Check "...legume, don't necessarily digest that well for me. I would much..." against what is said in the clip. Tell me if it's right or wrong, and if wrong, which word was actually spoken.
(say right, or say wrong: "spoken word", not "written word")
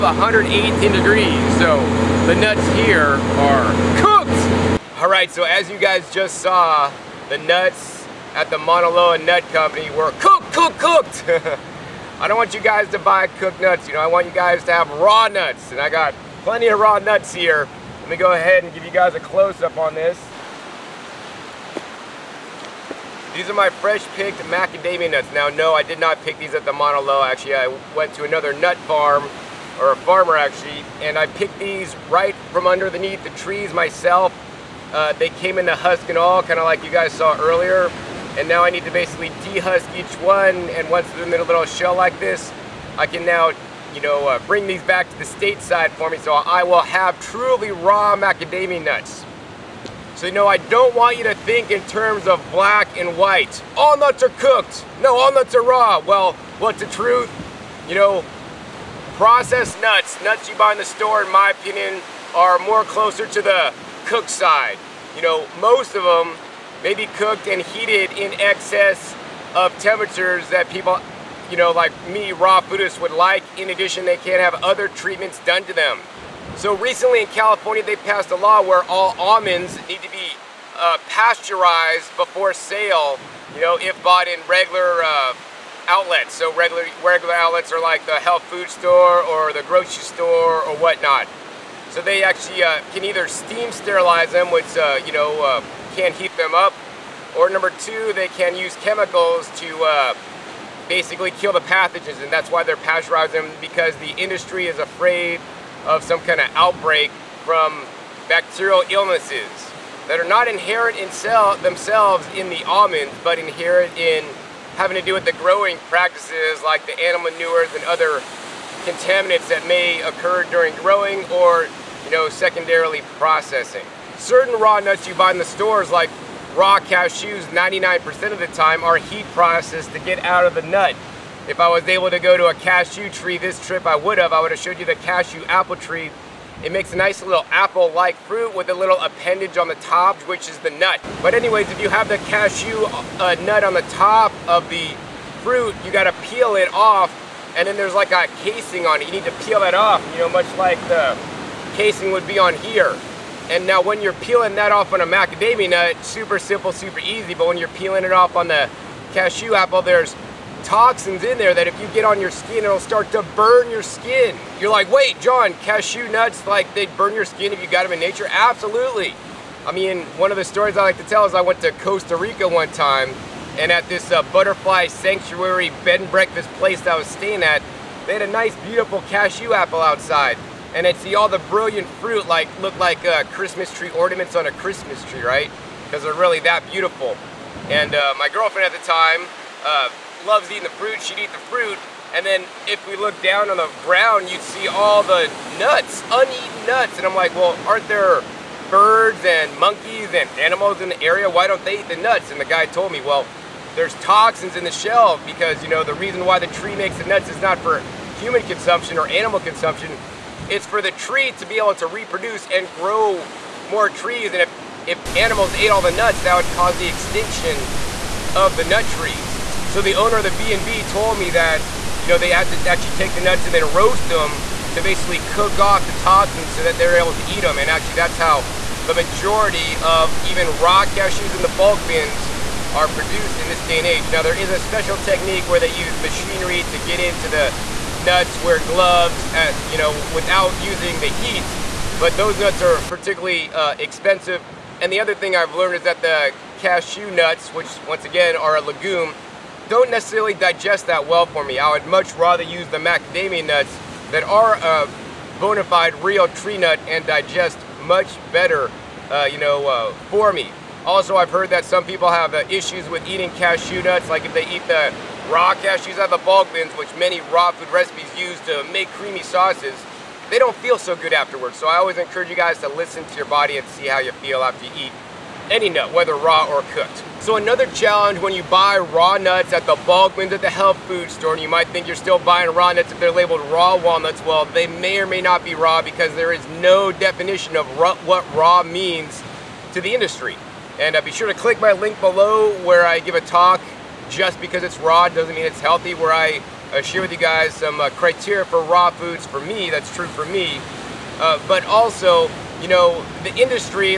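right.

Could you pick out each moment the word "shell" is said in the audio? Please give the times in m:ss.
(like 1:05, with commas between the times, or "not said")
0:41, 3:24.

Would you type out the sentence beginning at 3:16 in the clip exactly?
And I'm like, well, aren't there birds and monkeys and animals in the area?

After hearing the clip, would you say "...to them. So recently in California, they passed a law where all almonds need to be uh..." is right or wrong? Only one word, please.
right.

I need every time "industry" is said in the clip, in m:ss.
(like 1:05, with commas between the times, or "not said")
1:44, 4:49, 5:03.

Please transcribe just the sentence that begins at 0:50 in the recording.
So no, I don't want you to think in terms of black and white.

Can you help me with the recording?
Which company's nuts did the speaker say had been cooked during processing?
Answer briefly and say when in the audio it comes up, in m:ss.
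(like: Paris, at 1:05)
Mauna Loa Nut Company, at 0:08.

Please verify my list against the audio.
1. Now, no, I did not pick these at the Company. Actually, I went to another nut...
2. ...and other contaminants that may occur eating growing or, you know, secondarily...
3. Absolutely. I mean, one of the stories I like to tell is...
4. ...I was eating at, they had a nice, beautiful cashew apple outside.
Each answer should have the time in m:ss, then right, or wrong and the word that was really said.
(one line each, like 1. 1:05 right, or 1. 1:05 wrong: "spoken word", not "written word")
1. 0:25 wrong: "Loa", not "Company"
2. 1:57 wrong: "during", not "eating"
3. 2:48 right
4. 2:56 wrong: "staying", not "eating".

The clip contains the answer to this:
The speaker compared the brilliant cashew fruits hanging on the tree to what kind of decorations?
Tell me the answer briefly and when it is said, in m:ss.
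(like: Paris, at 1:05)
Christmas tree ornaments, at 3:03.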